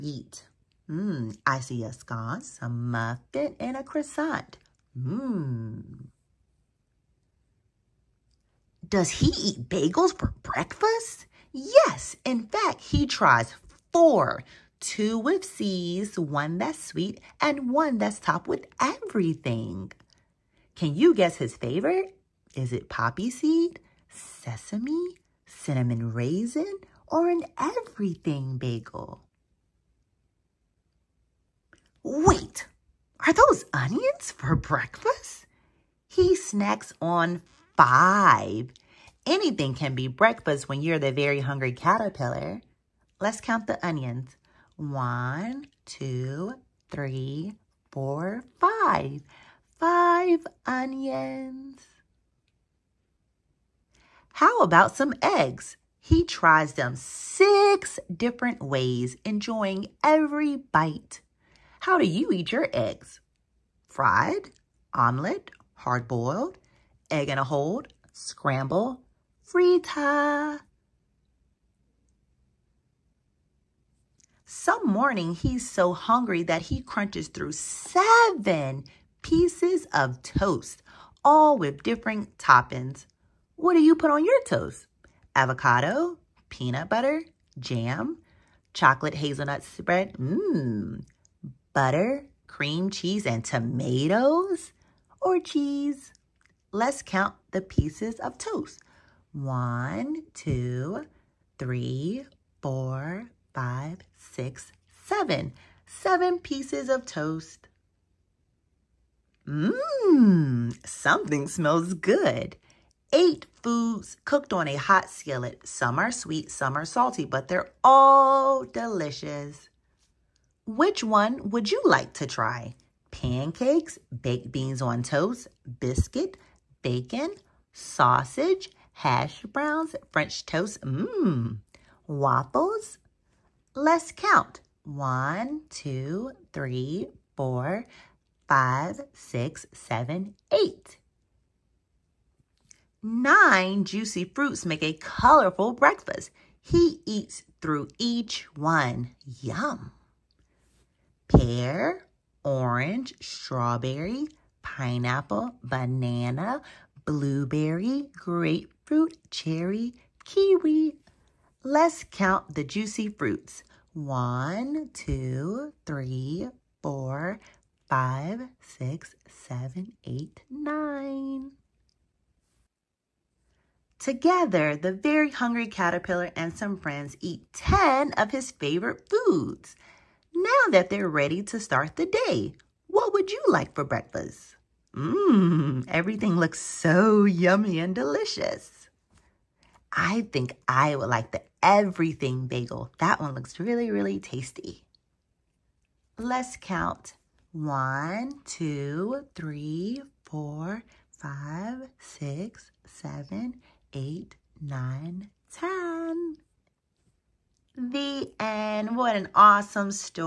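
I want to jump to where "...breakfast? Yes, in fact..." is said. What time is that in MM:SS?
00:10.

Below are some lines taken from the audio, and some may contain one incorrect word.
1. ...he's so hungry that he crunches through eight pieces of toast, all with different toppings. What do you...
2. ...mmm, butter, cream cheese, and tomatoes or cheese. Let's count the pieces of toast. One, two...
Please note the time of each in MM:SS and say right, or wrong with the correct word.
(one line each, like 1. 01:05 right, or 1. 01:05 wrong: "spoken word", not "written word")
1. 01:15 wrong: "seven", not "eight"
2. 01:30 right.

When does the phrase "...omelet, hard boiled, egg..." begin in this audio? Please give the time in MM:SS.
01:04.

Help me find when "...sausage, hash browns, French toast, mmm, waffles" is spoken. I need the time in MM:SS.
02:07.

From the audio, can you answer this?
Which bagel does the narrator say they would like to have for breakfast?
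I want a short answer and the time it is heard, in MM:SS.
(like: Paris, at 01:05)
the everything bagel, at 03:11.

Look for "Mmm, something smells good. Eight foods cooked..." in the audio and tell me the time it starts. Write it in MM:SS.
01:49.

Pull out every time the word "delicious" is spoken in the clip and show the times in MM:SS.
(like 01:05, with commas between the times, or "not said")
01:58, 03:07.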